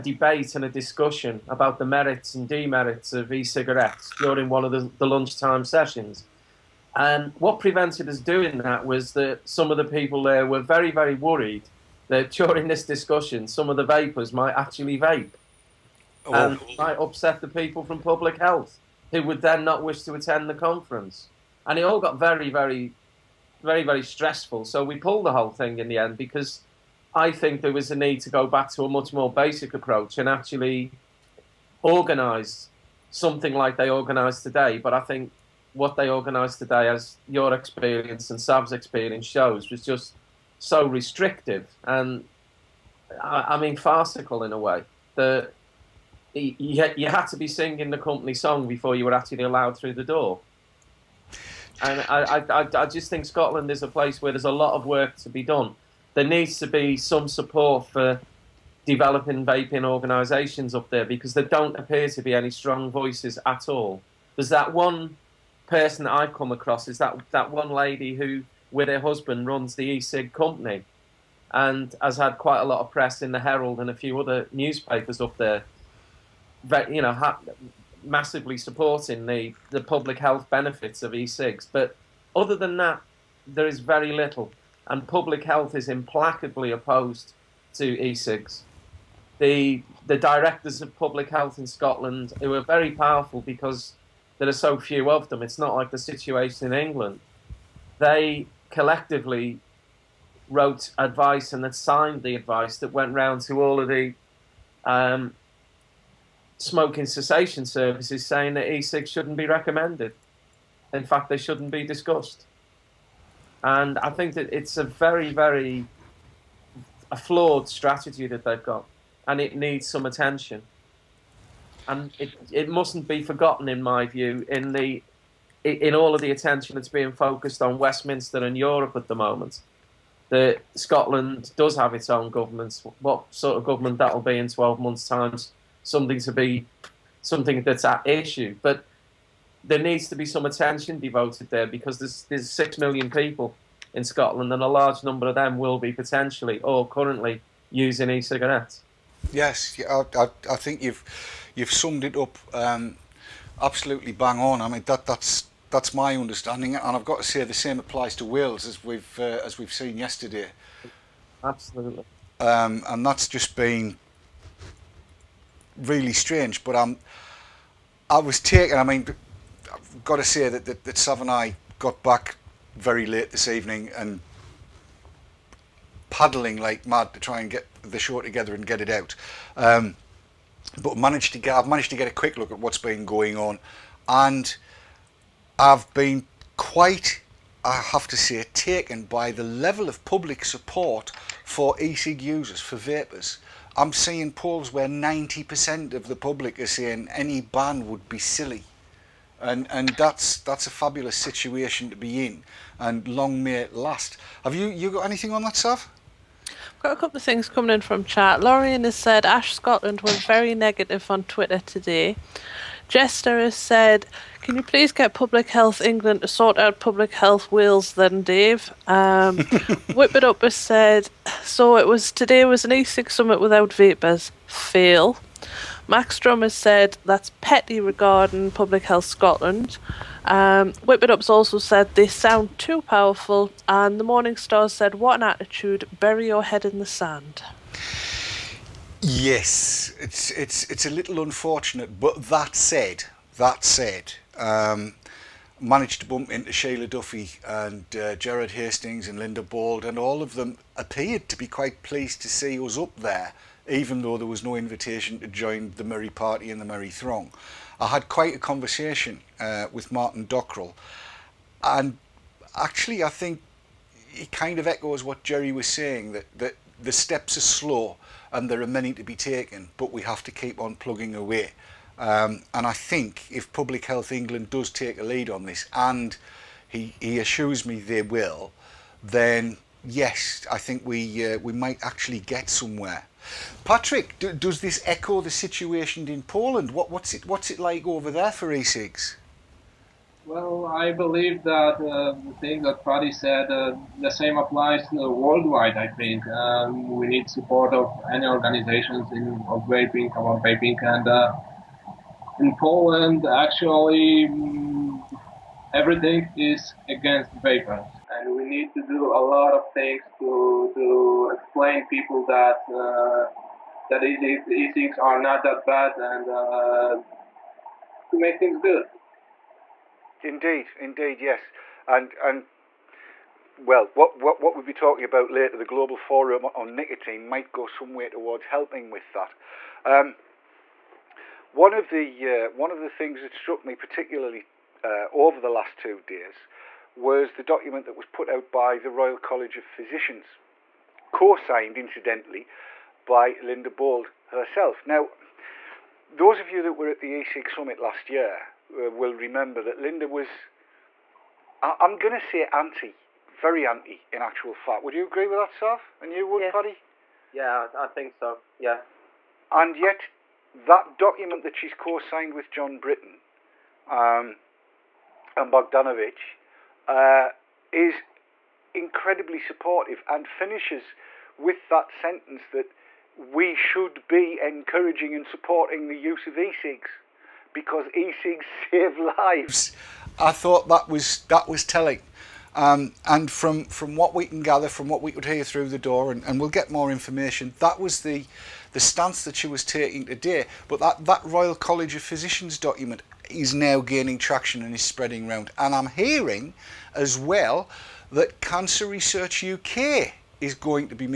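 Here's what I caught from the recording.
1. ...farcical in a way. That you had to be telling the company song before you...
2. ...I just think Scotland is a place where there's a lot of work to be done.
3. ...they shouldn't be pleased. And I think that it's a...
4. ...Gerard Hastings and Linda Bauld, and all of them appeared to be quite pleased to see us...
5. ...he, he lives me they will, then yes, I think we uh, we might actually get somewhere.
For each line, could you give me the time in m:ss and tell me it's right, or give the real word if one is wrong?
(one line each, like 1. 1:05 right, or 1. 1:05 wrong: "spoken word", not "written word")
1. 0:43 wrong: "singing", not "telling"
2. 0:52 right
3. 1:51 wrong: "discussed", not "pleased"
4. 4:08 right
5. 4:36 wrong: "assures", not "lives".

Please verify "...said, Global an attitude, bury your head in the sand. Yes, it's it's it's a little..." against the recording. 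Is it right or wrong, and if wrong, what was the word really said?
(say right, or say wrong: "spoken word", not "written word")
wrong: "What", not "Global".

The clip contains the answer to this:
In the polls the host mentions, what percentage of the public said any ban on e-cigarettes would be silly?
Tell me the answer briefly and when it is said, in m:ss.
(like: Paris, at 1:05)
90%, at 3:14.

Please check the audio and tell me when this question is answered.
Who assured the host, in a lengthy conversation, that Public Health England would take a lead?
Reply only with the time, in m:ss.
4:19.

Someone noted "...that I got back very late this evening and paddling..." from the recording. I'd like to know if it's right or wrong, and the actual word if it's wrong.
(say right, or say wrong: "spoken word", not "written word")
right.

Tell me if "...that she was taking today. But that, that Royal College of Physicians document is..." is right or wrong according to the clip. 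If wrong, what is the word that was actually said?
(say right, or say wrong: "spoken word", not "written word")
right.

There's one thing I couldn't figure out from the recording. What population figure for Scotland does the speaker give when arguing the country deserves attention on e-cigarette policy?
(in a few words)
6 million.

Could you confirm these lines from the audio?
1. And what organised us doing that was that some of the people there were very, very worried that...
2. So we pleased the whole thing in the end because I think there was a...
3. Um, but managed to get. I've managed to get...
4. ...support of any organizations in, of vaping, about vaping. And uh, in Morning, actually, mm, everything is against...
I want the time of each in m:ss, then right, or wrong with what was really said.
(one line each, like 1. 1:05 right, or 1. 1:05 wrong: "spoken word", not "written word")
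1. 0:06 wrong: "prevented", not "organised"
2. 0:24 wrong: "pulled", not "pleased"
3. 2:59 right
4. 4:57 wrong: "Poland", not "Morning".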